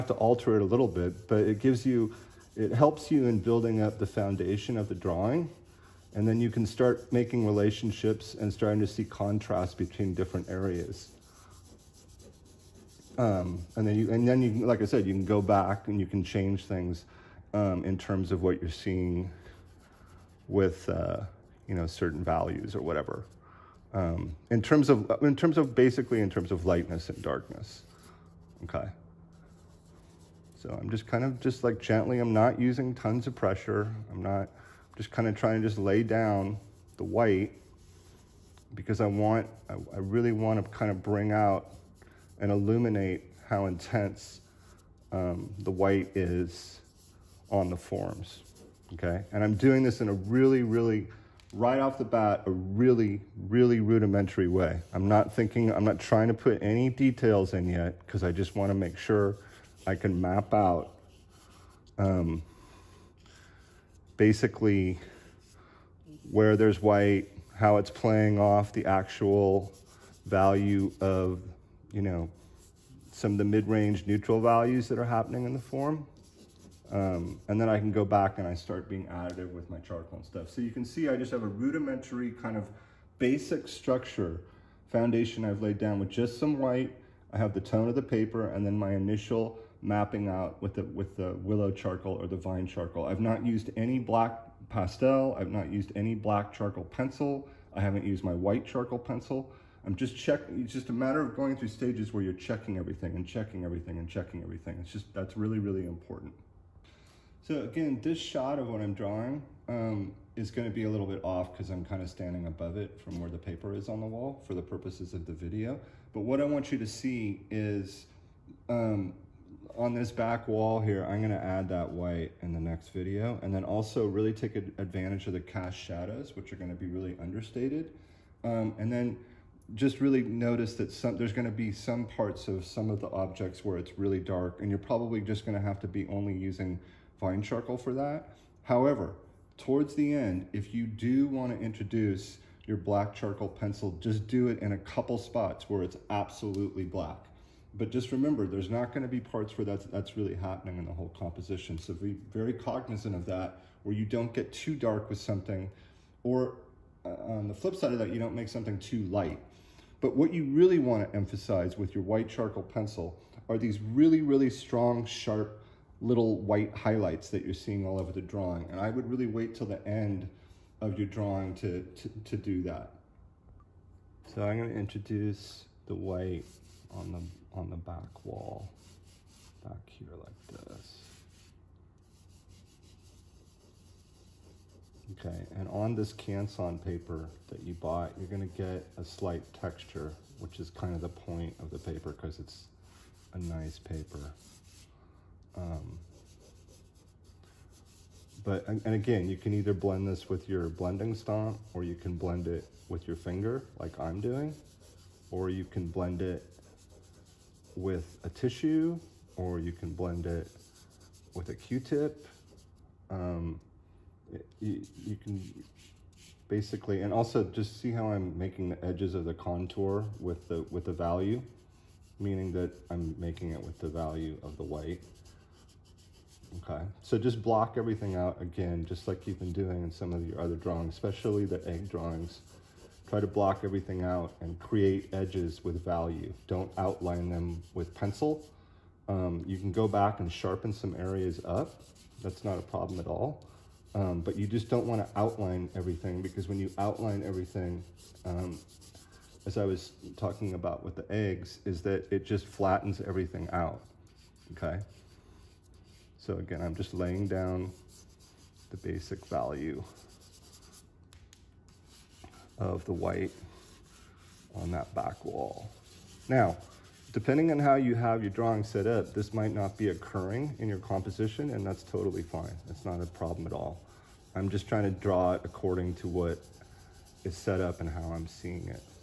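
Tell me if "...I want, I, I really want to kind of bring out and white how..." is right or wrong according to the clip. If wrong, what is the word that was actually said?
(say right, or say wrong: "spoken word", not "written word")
wrong: "illuminate", not "white".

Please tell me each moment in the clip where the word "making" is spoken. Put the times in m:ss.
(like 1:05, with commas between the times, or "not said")
0:07, 3:38, 3:43.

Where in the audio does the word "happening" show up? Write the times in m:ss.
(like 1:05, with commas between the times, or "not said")
1:15, 2:30.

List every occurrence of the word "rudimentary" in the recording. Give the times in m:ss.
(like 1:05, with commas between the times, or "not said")
0:53, 1:21.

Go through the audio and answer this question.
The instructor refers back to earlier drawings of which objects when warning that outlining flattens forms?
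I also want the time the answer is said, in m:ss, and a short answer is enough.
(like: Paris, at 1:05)
eggs, at 3:51.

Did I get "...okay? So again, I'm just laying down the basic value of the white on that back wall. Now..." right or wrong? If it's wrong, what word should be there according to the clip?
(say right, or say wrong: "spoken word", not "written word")
right.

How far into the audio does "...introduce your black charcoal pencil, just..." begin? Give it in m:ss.
2:21.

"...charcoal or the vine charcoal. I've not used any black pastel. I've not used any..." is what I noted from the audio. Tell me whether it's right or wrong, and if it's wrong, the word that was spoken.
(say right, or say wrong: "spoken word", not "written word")
right.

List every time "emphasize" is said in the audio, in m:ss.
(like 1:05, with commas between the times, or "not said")
2:41.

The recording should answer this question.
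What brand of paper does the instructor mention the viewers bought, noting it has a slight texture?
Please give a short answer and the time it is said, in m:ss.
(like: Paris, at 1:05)
Canson, at 3:06.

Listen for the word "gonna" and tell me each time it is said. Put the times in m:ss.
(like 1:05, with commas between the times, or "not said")
2:28, 2:54, 3:08.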